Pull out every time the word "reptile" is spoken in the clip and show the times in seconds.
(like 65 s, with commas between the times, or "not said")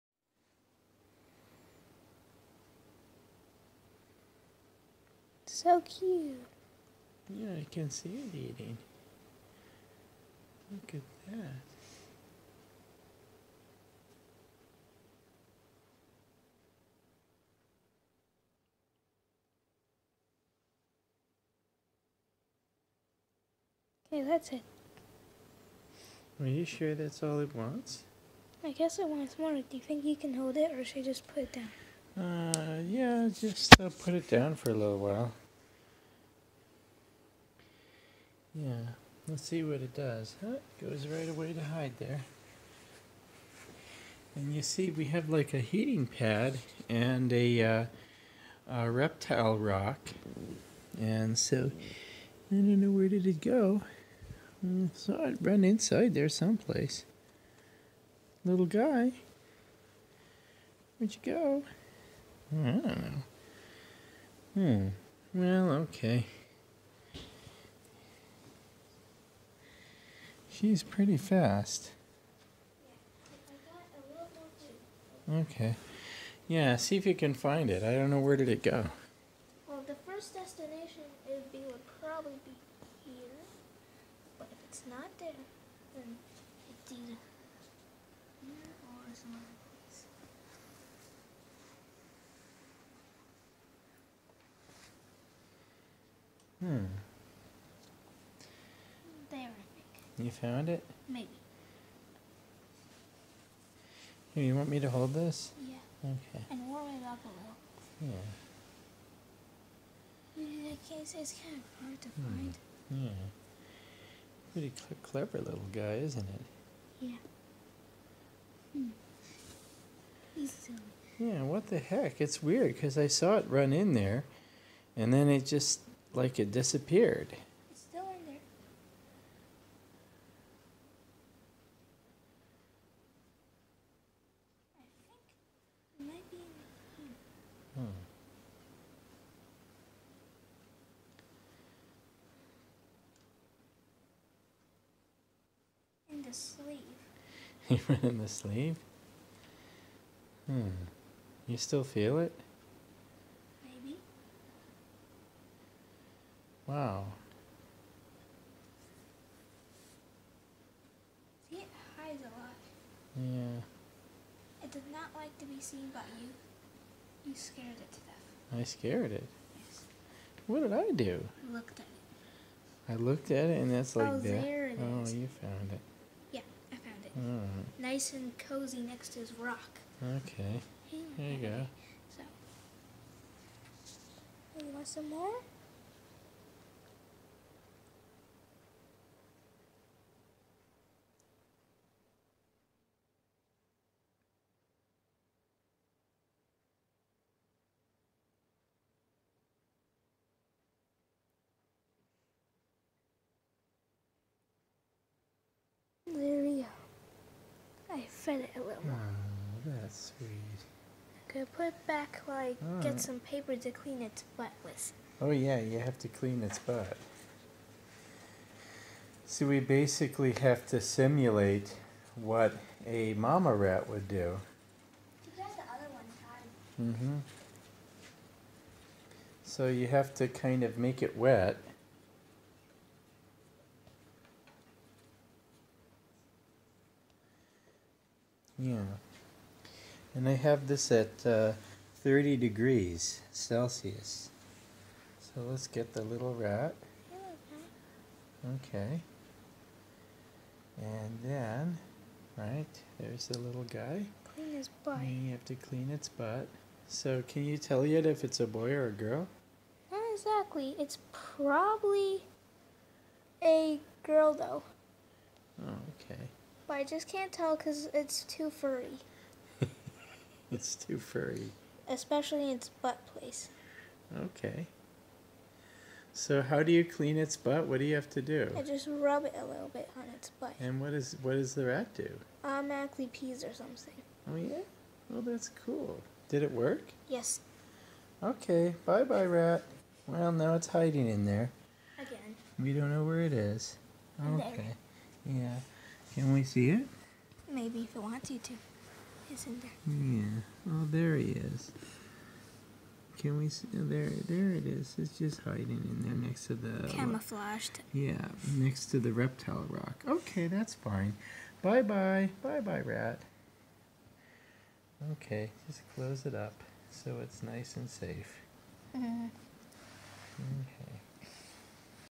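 48 s, 309 s.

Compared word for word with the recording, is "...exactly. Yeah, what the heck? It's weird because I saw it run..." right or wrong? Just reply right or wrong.
wrong.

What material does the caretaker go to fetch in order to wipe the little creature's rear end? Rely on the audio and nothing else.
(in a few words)
paper.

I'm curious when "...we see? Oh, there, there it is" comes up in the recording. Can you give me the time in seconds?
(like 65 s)
303 s.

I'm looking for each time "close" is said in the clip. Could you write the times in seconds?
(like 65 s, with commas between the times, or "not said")
315 s.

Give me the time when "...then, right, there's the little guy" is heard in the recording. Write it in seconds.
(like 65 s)
251 s.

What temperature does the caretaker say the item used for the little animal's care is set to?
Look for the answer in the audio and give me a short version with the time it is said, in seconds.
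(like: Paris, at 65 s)
30 degrees Celsius, at 242 s.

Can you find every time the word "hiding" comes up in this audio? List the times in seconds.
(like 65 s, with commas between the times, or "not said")
290 s, 305 s.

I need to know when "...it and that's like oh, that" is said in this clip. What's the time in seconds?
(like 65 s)
173 s.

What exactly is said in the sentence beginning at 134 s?
I think it might be in Hmm.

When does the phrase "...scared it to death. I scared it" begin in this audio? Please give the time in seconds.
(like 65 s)
167 s.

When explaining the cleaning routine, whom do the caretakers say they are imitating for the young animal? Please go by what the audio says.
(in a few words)
mama rat.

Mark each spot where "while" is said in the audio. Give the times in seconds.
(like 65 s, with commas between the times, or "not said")
34 s, 212 s.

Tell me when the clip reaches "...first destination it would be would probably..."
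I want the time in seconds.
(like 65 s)
80 s.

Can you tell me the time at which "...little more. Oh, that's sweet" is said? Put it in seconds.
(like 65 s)
208 s.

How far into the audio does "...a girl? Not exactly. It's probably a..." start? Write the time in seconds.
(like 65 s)
258 s.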